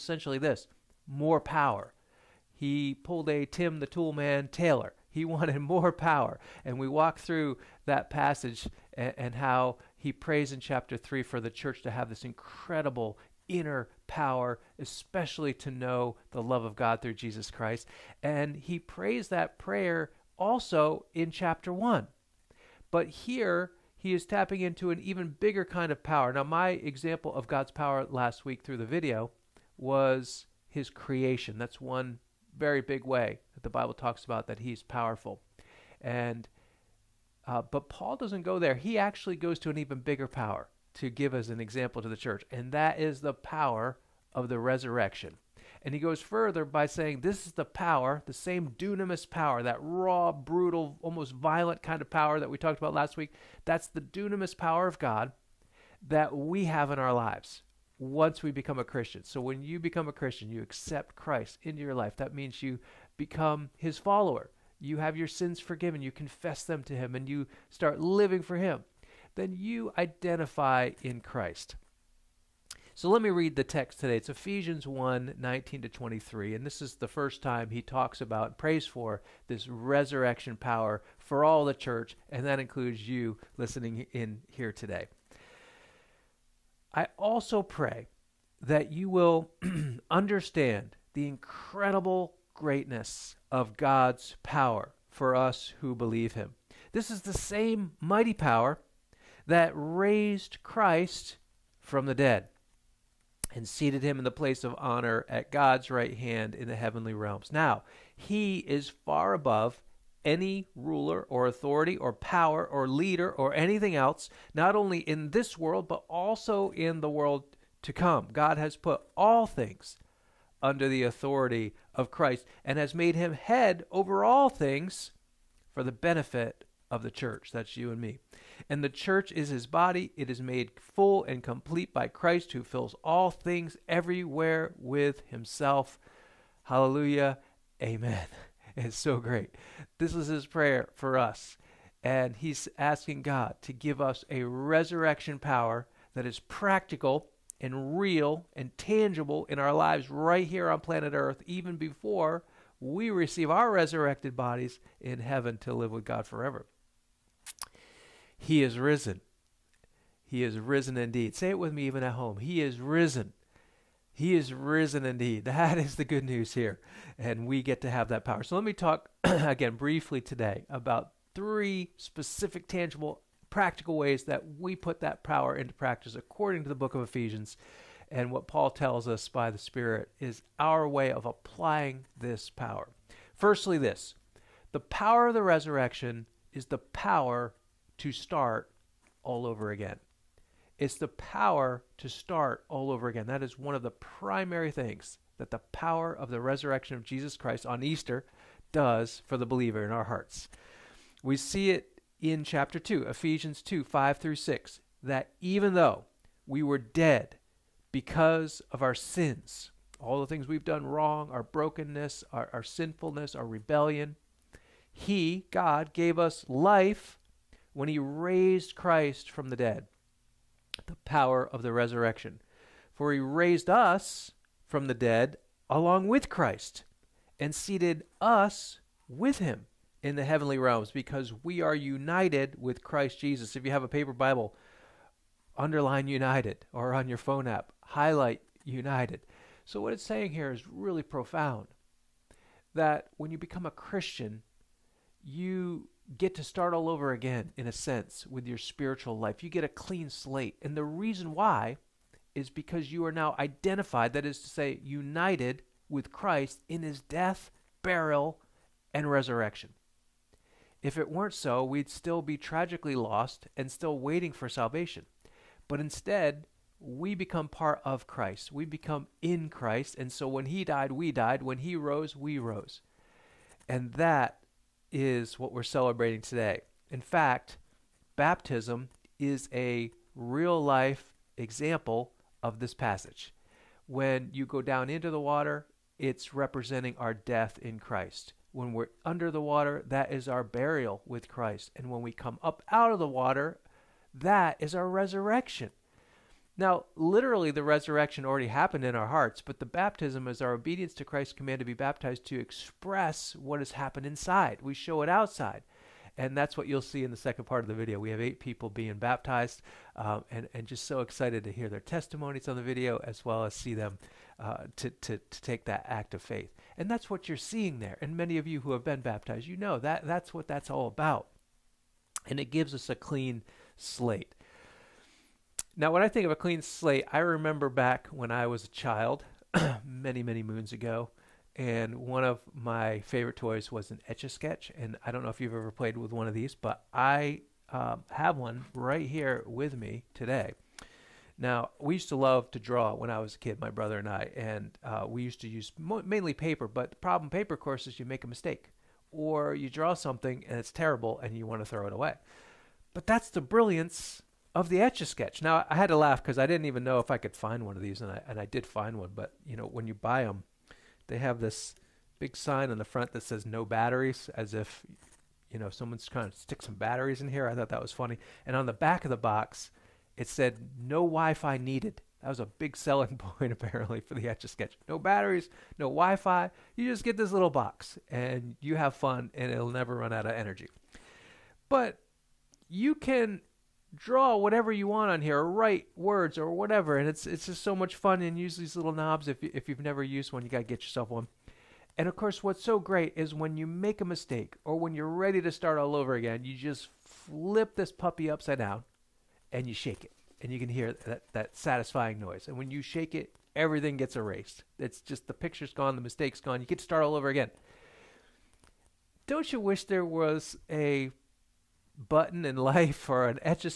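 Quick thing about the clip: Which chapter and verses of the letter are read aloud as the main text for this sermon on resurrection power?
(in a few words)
Ephesians 1:19-23.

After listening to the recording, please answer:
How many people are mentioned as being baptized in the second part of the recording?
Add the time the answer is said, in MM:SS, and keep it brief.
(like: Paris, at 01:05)
8, at 05:08.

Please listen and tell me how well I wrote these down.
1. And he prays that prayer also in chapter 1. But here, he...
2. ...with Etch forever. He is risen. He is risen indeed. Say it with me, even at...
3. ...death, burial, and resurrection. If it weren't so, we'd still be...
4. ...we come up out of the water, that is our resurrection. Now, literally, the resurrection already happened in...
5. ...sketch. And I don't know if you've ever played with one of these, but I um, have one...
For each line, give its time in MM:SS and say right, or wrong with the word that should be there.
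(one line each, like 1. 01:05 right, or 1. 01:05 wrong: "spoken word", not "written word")
1. 00:18 right
2. 02:35 wrong: "God", not "Etch"
3. 04:17 right
4. 04:52 right
5. 05:34 right.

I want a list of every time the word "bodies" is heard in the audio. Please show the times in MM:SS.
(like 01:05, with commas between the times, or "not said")
02:34.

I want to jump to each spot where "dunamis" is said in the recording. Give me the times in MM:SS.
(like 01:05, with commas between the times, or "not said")
00:48, 00:54.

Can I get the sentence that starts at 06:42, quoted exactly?
And when you shake it, everything gets erased.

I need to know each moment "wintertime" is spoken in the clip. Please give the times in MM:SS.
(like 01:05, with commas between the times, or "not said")
not said.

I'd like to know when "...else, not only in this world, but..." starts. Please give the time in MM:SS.
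01:53.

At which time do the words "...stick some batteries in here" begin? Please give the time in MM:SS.
06:06.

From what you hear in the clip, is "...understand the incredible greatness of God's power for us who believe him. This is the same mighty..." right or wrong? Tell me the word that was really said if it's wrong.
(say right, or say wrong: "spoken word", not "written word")
right.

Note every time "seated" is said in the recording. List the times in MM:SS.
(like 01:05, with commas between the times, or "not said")
01:43, 03:47.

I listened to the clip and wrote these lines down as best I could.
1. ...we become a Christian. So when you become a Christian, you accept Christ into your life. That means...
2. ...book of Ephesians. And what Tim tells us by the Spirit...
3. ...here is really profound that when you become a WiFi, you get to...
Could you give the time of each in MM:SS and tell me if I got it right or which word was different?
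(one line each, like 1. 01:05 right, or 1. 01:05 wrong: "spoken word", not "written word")
1. 00:58 right
2. 02:56 wrong: "Paul", not "Tim"
3. 04:00 wrong: "Christian", not "WiFi".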